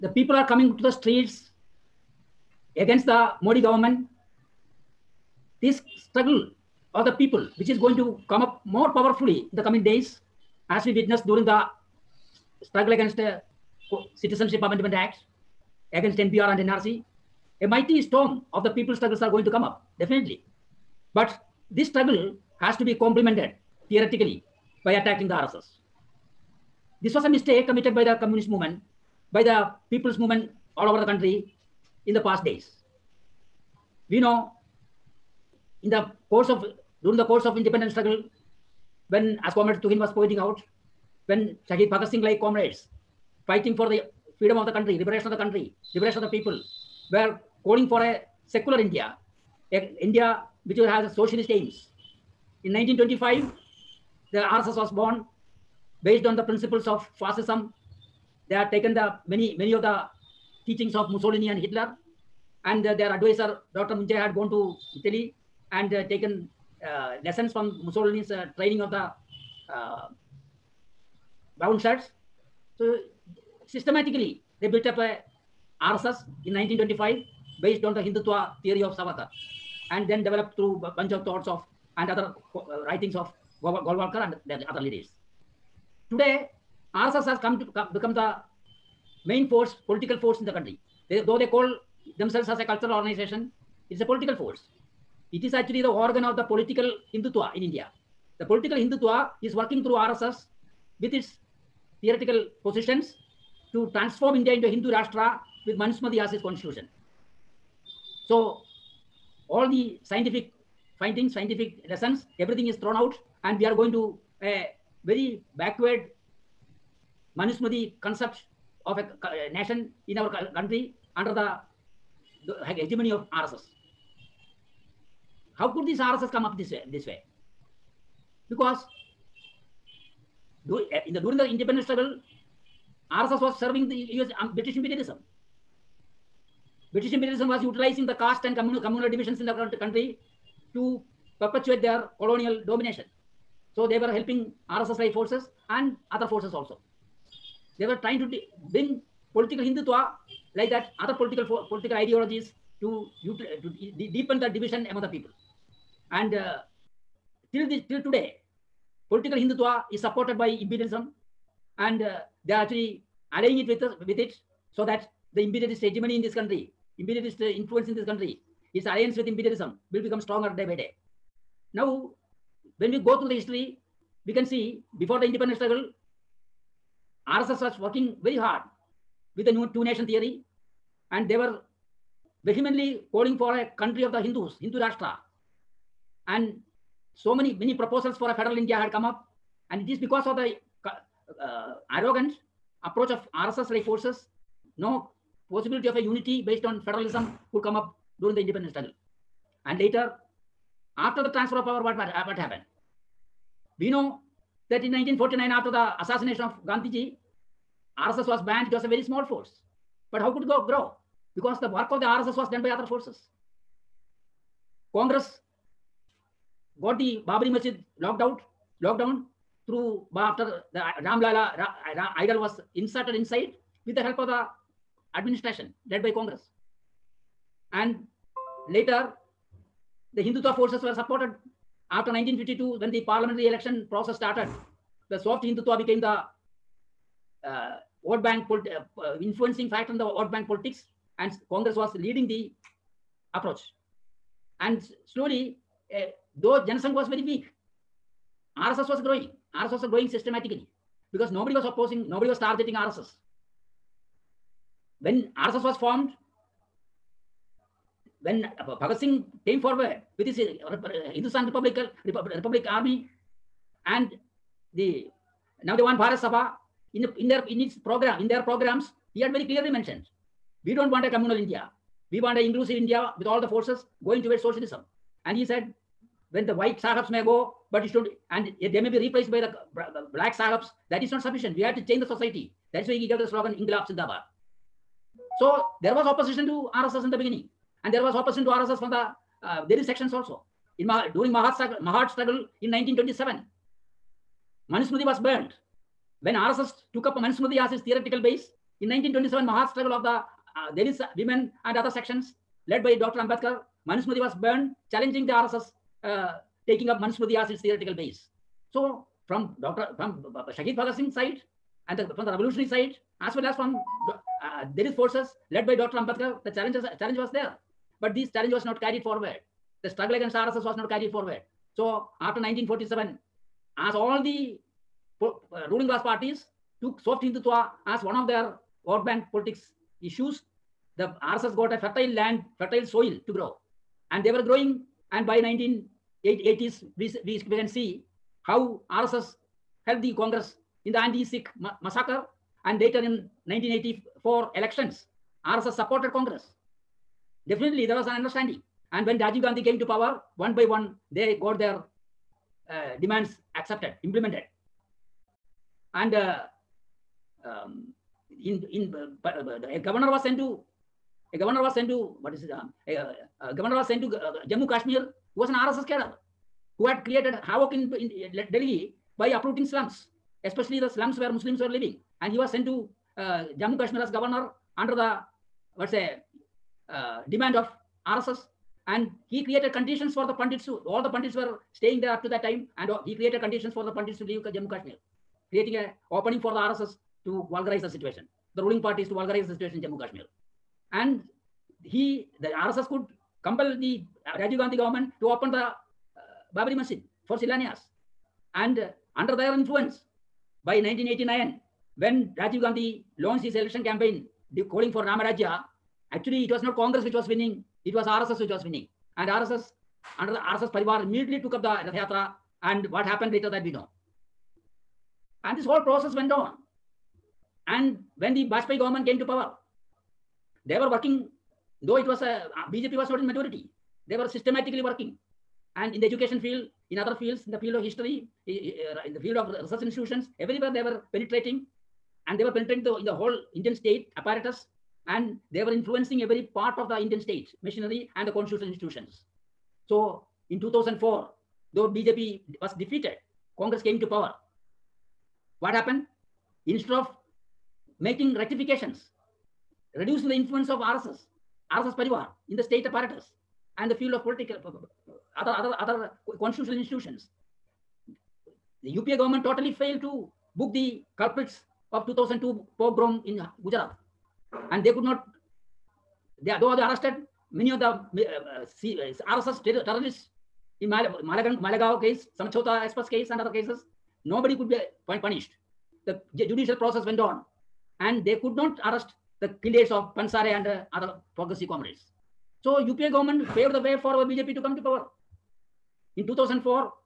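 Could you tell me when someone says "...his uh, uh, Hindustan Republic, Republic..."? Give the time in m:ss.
4:20.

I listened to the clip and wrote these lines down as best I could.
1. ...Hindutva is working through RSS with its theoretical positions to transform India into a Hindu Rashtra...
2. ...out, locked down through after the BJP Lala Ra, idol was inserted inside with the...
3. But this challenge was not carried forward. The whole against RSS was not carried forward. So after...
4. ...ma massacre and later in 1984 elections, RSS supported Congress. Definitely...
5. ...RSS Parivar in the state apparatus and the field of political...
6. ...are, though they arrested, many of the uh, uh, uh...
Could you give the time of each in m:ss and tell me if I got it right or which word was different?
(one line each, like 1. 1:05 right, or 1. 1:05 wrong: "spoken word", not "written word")
1. 1:38 right
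2. 3:38 wrong: "Ram", not "BJP"
3. 5:18 wrong: "struggle", not "whole"
4. 5:41 right
5. 7:31 right
6. 7:46 right.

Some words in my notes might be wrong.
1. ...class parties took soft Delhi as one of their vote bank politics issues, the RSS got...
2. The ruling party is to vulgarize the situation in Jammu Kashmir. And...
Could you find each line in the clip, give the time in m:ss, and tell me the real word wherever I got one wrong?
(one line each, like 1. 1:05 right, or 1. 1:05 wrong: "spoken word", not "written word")
1. 5:25 wrong: "Hindutva", not "Delhi"
2. 6:28 right.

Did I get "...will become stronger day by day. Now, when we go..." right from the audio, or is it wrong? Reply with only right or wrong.
right.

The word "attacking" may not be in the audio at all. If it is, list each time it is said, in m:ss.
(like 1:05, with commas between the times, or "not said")
0:24.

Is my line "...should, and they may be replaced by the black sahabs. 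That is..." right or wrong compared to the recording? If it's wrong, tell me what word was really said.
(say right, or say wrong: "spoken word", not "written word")
right.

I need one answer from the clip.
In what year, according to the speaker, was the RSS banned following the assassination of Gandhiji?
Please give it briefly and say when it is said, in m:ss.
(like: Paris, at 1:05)
1949, at 3:24.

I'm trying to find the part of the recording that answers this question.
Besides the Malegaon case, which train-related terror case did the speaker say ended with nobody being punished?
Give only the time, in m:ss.
7:52.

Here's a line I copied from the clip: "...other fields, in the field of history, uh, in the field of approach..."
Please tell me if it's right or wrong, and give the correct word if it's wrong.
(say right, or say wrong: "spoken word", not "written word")
wrong: "research", not "approach".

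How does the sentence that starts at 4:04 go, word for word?
And slowly, uh, though Janasangh was very weak, RSS was growing.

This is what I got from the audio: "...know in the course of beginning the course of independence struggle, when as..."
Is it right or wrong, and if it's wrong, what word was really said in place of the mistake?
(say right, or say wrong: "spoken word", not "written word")
wrong: "during", not "beginning".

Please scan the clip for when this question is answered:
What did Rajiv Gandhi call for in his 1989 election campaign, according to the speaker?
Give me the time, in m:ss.
6:45.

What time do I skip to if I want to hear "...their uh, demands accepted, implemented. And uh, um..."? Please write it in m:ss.
5:51.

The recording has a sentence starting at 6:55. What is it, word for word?
And this whole process went on.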